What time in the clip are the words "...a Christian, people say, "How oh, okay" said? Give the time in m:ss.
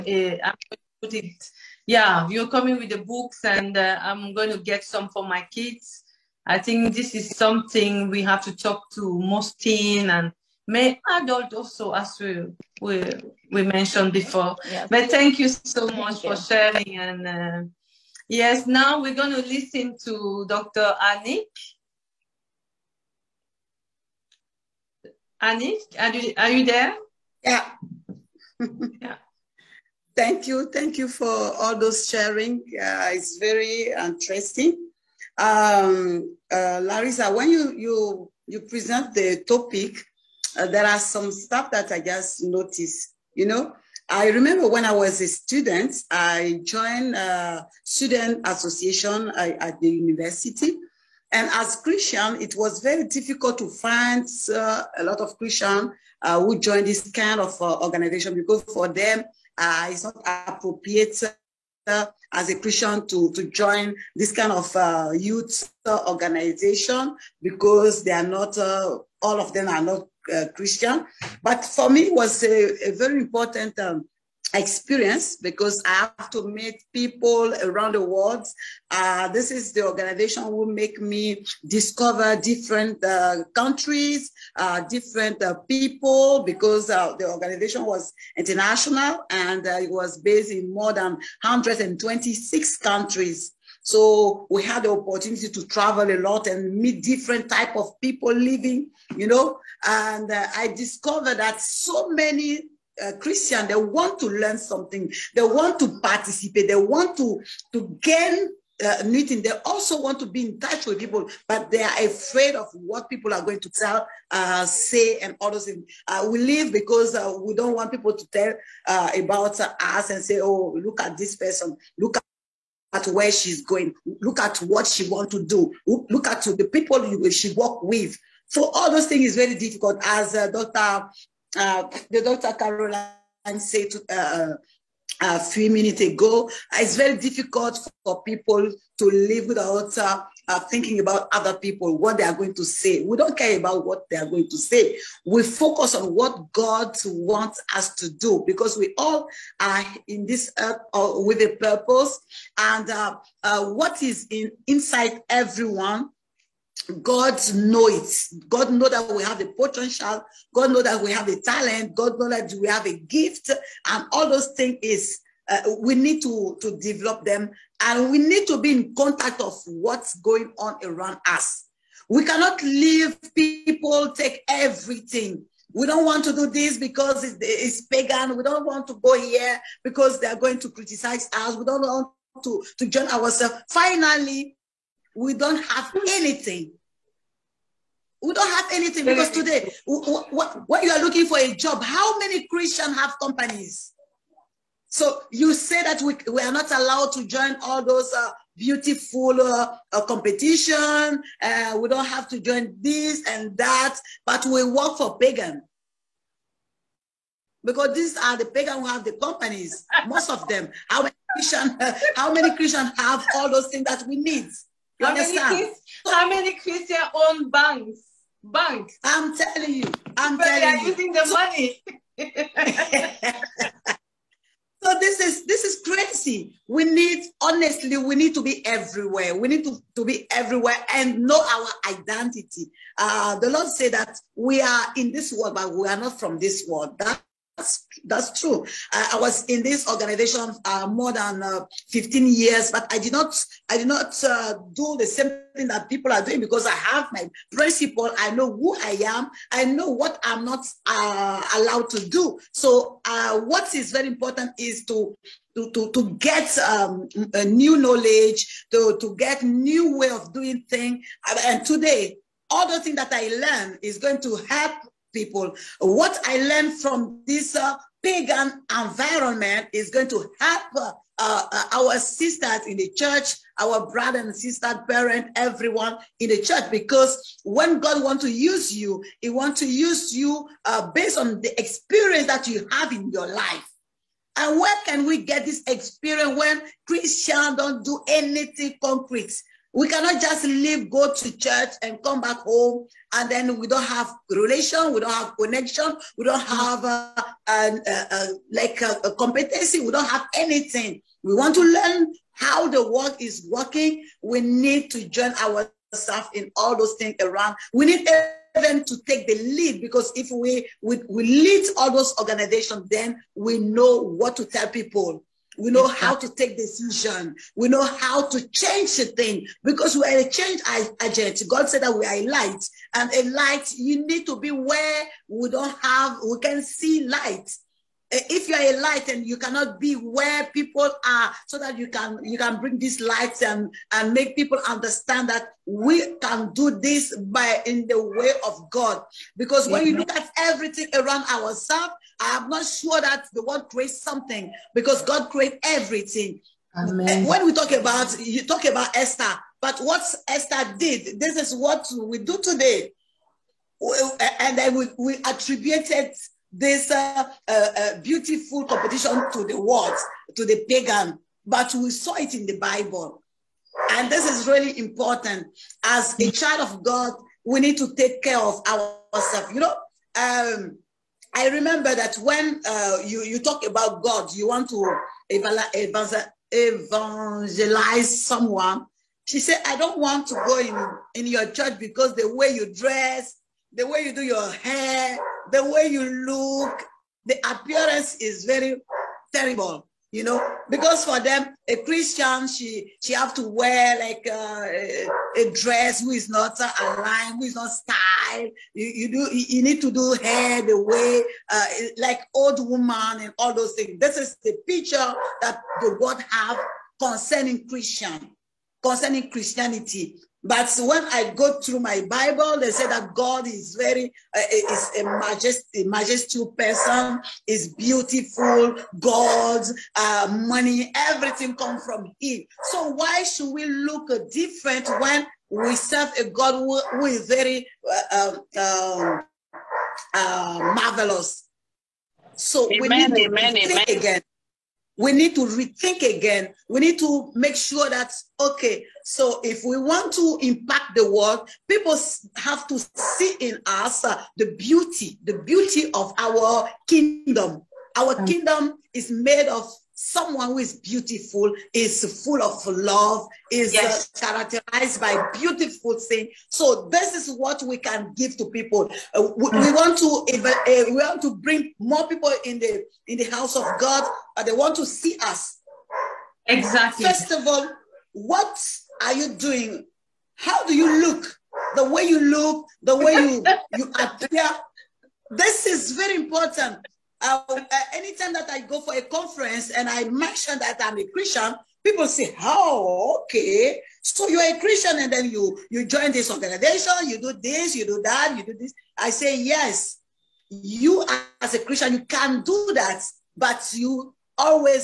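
8:00.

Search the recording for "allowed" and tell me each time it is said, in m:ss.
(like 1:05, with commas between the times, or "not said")
3:16, 4:11.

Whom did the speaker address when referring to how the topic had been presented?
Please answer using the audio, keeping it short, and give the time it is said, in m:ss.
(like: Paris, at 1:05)
Larisa, at 0:36.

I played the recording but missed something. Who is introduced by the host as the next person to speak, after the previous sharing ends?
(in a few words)
Dr. Anik.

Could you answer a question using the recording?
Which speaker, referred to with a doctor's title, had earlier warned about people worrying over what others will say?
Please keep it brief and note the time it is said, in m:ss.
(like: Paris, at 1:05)
Dr. Caroline, at 2:12.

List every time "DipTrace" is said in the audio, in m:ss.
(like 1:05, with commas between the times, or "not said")
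not said.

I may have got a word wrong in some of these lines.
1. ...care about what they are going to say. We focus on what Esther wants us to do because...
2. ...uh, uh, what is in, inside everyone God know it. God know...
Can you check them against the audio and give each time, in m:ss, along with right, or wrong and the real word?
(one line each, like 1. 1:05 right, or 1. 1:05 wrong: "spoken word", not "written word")
1. 2:23 wrong: "God", not "Esther"
2. 2:32 right.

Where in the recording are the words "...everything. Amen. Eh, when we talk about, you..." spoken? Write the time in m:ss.
5:45.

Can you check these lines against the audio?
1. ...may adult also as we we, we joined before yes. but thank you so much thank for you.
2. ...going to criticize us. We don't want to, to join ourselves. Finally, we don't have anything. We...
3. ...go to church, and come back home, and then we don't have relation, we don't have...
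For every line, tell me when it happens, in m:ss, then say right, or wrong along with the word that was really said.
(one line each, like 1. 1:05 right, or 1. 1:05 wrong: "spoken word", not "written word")
1. 0:10 wrong: "mentioned", not "joined"
2. 3:00 right
3. 4:50 right.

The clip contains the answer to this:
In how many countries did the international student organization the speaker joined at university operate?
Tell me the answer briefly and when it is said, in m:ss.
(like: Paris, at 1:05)
126, at 1:31.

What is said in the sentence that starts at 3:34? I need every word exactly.
You how Many, how many Christian own banks?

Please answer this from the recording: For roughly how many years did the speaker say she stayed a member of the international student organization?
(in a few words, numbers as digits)
15.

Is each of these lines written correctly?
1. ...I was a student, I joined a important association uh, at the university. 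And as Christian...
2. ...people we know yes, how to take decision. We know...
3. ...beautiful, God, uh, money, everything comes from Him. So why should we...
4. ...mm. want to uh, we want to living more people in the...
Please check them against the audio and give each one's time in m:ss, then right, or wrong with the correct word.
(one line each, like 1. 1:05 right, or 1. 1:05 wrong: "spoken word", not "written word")
1. 0:44 wrong: "student", not "important"
2. 5:14 right
3. 6:57 right
4. 7:39 wrong: "bring", not "living".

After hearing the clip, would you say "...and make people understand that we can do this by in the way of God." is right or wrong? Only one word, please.
right.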